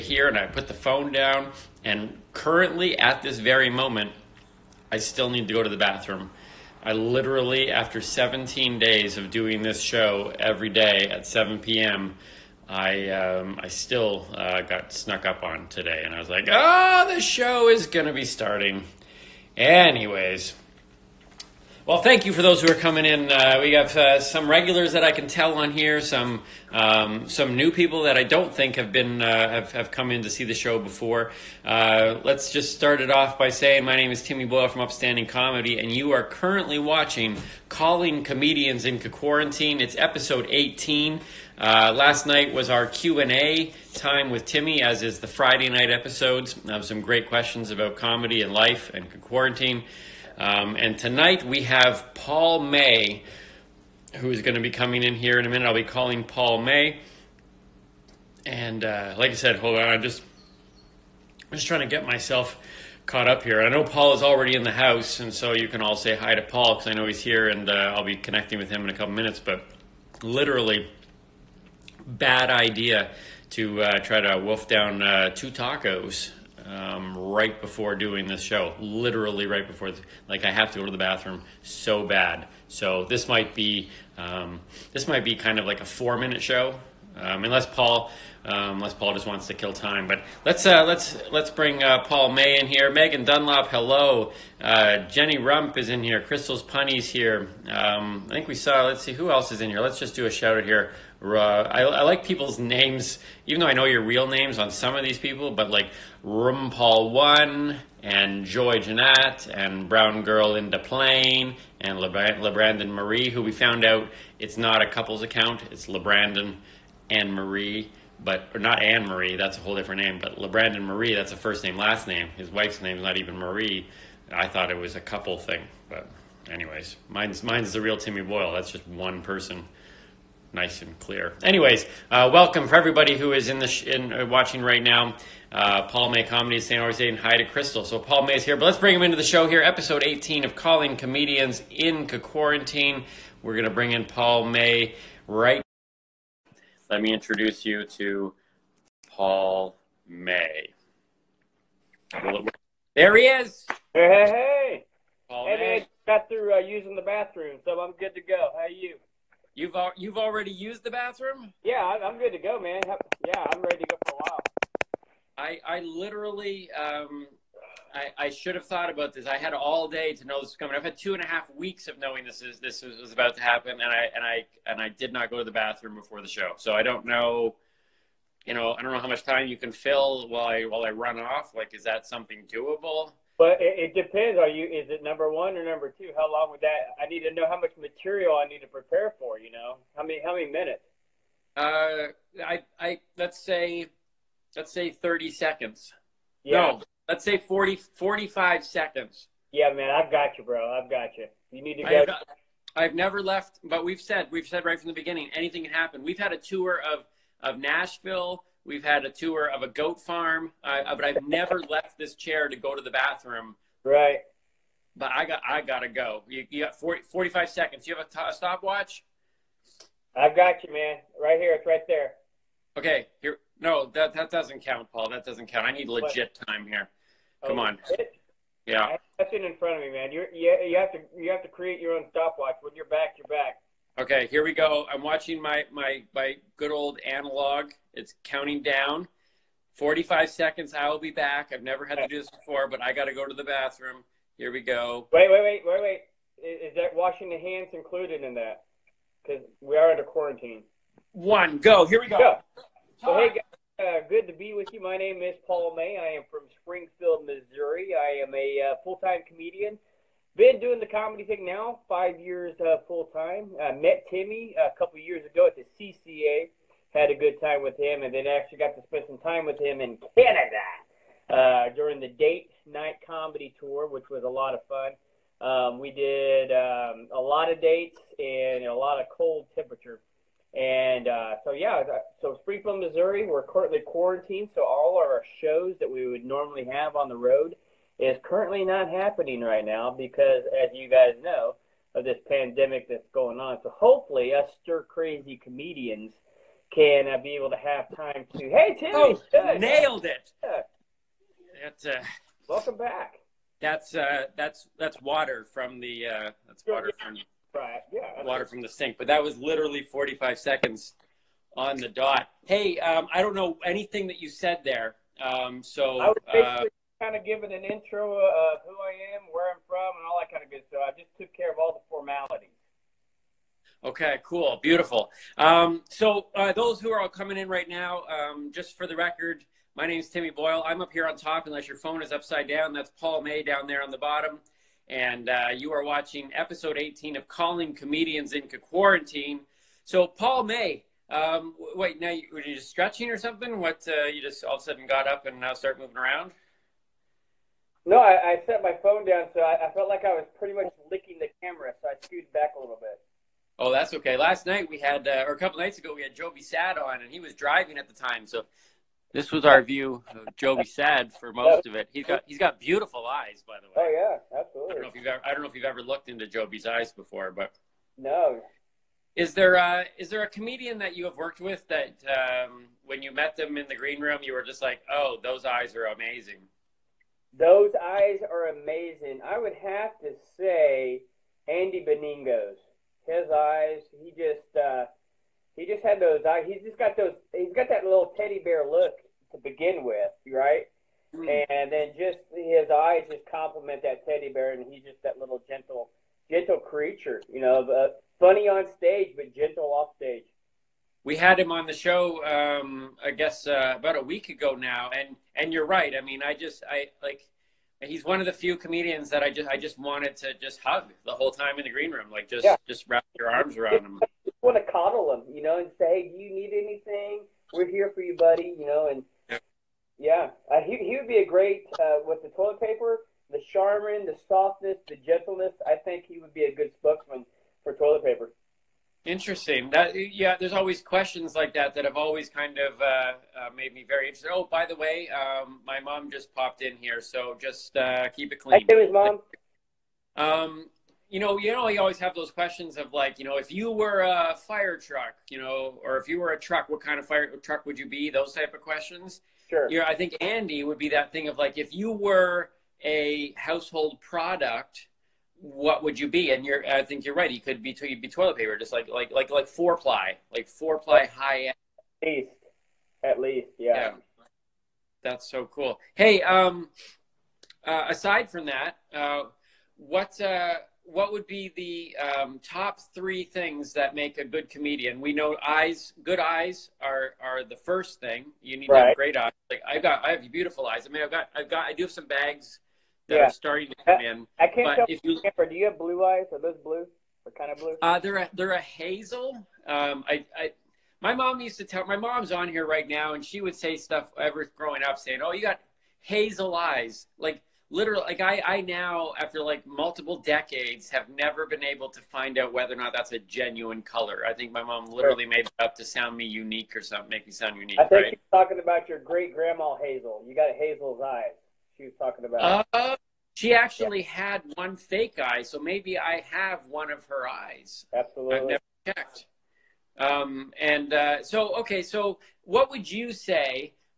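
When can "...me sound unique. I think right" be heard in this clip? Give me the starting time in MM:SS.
08:27.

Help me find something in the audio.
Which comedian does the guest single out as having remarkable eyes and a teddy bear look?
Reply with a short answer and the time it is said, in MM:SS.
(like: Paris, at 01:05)
Andy Beningos, at 06:21.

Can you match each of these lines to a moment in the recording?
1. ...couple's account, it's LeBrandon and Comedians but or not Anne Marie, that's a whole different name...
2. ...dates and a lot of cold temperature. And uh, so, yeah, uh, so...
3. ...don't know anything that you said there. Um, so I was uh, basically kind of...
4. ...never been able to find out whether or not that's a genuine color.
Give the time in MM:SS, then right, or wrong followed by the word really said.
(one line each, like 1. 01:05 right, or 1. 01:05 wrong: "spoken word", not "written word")
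1. 01:54 wrong: "Marie", not "Comedians"
2. 04:37 right
3. 05:13 right
4. 08:21 right.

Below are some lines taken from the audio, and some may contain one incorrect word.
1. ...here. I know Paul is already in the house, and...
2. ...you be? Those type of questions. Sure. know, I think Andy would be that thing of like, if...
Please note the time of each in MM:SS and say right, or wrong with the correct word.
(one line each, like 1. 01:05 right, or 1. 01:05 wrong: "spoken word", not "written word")
1. 01:03 right
2. 07:27 right.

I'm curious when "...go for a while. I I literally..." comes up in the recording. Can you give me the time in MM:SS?
02:43.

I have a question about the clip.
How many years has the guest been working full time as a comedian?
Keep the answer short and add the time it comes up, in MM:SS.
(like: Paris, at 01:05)
5, at 04:21.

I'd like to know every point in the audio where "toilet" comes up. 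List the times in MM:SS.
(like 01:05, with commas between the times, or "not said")
07:02, 07:07, 07:38.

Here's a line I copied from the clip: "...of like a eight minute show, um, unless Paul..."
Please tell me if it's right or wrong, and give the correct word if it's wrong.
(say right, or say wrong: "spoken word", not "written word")
wrong: "four", not "eight".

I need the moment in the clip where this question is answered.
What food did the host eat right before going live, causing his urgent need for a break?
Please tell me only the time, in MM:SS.
01:15.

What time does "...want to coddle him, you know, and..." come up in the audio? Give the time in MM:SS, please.
06:54.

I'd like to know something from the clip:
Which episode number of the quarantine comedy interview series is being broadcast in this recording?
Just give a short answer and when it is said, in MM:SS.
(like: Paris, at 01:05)
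18, at 00:39.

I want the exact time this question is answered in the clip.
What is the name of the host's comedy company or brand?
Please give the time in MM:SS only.
00:34.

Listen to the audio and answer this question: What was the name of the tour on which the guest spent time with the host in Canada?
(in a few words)
date night comedy tour.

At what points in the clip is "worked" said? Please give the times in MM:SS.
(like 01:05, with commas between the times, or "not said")
06:11.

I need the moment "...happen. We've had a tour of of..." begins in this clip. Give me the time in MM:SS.
03:25.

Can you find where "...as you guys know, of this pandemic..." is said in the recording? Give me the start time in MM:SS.
04:50.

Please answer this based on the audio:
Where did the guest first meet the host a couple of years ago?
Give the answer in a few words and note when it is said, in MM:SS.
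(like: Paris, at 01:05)
the CCA, at 04:25.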